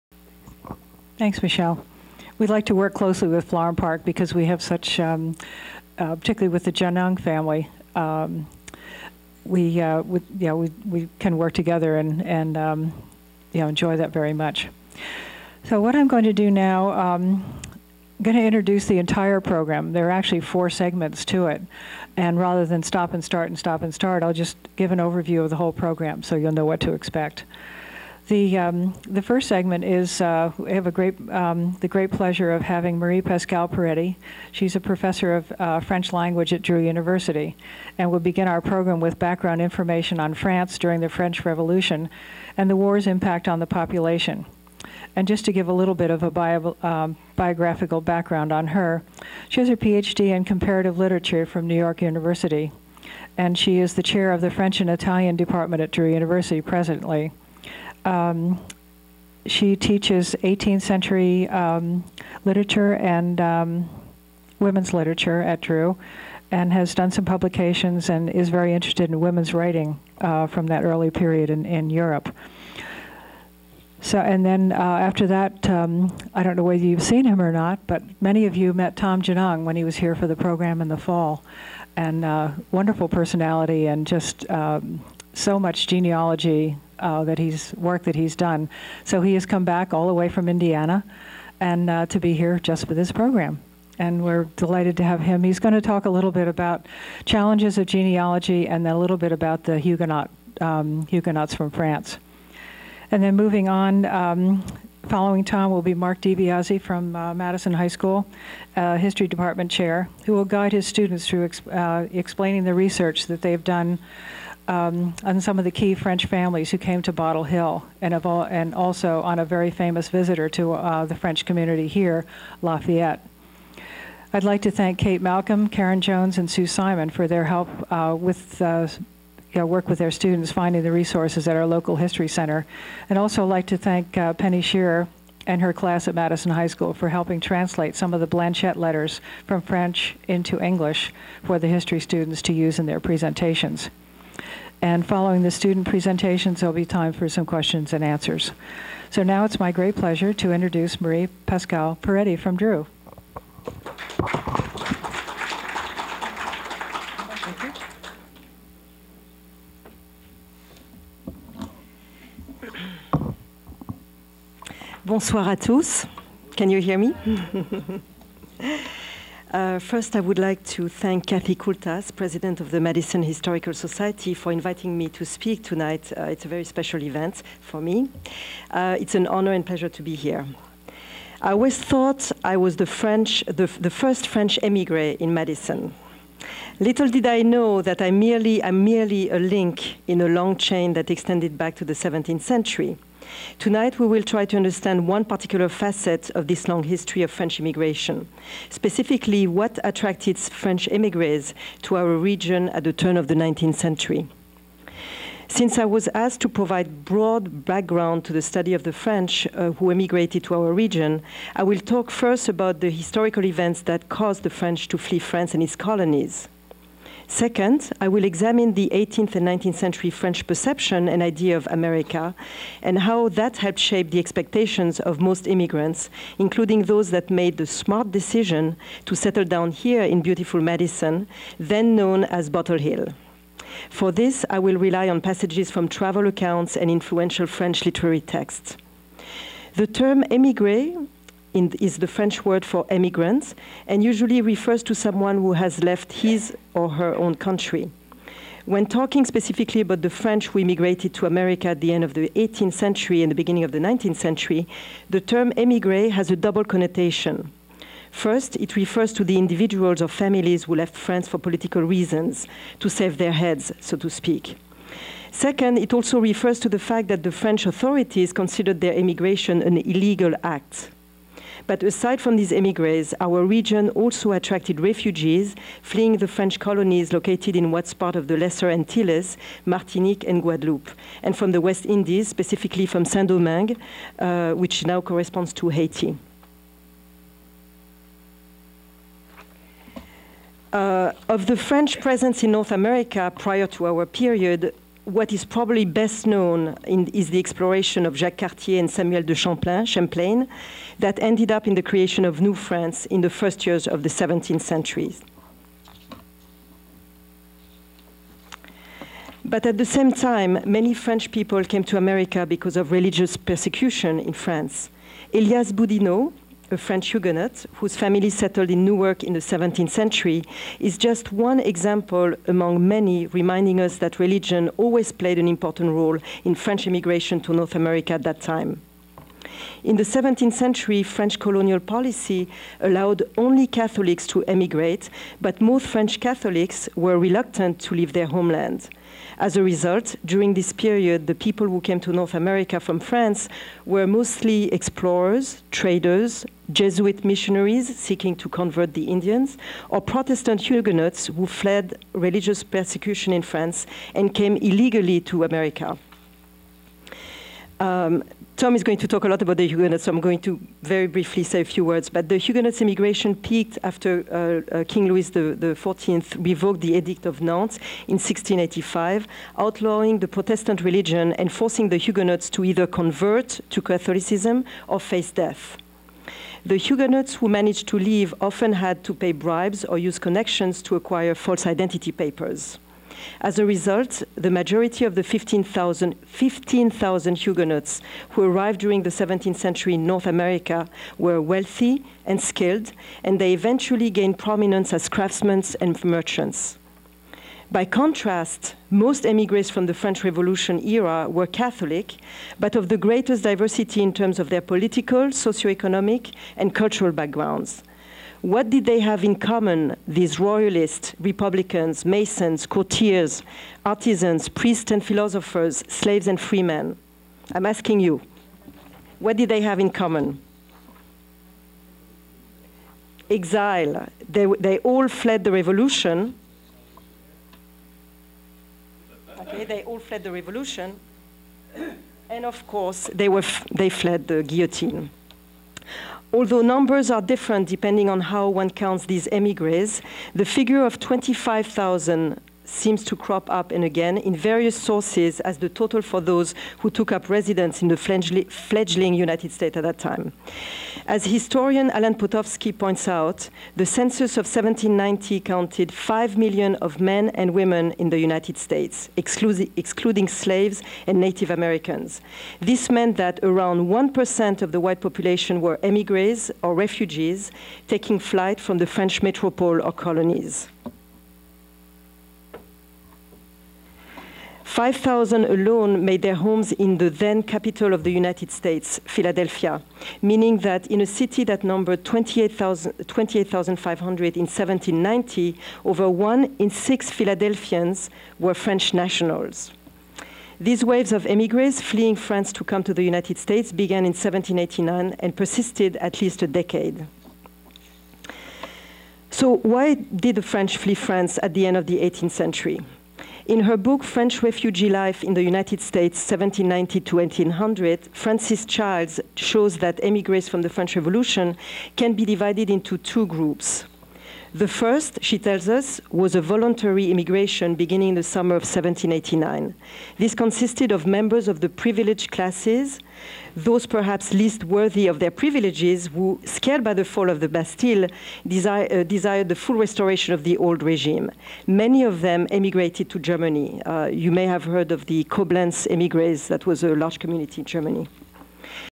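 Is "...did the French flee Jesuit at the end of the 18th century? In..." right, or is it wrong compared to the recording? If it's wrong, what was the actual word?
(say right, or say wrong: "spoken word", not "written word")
wrong: "France", not "Jesuit".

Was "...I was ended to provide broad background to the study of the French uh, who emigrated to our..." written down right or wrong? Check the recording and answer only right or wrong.
wrong.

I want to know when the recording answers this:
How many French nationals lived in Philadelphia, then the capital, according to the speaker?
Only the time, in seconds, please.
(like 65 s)
474 s.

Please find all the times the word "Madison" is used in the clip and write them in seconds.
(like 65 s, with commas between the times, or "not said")
107 s, 136 s, 172 s, 185 s, 230 s.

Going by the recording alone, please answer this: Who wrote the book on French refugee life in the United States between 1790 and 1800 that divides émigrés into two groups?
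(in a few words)
Frances Childs.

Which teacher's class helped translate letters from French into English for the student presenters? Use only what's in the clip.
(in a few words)
Penny Shearer.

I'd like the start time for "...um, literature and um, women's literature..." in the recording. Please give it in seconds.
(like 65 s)
61 s.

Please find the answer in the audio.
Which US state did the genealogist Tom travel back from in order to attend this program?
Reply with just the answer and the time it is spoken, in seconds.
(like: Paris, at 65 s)
Indiana, at 90 s.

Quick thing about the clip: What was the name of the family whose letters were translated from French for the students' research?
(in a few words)
Blanchette.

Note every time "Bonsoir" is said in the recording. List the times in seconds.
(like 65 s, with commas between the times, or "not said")
165 s.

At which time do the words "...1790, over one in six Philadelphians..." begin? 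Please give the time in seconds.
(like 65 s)
484 s.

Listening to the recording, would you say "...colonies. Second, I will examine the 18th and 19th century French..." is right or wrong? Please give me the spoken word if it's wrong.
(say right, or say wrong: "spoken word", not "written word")
right.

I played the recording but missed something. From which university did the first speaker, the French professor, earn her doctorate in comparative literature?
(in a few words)
New York University.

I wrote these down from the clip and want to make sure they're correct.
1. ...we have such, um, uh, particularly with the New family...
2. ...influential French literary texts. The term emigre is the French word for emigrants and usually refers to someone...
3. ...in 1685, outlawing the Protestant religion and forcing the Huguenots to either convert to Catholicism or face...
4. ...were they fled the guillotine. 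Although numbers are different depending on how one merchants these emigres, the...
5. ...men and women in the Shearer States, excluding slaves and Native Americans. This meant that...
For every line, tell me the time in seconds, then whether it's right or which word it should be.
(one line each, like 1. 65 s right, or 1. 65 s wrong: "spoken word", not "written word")
1. 4 s wrong: "Genung", not "New"
2. 236 s right
3. 368 s right
4. 433 s wrong: "counts", not "merchants"
5. 457 s wrong: "United", not "Shearer".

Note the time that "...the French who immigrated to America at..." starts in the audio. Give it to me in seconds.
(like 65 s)
250 s.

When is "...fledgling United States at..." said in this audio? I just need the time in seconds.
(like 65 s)
447 s.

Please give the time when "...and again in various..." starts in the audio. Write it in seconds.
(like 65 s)
443 s.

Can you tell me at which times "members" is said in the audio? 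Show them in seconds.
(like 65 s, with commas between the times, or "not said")
521 s.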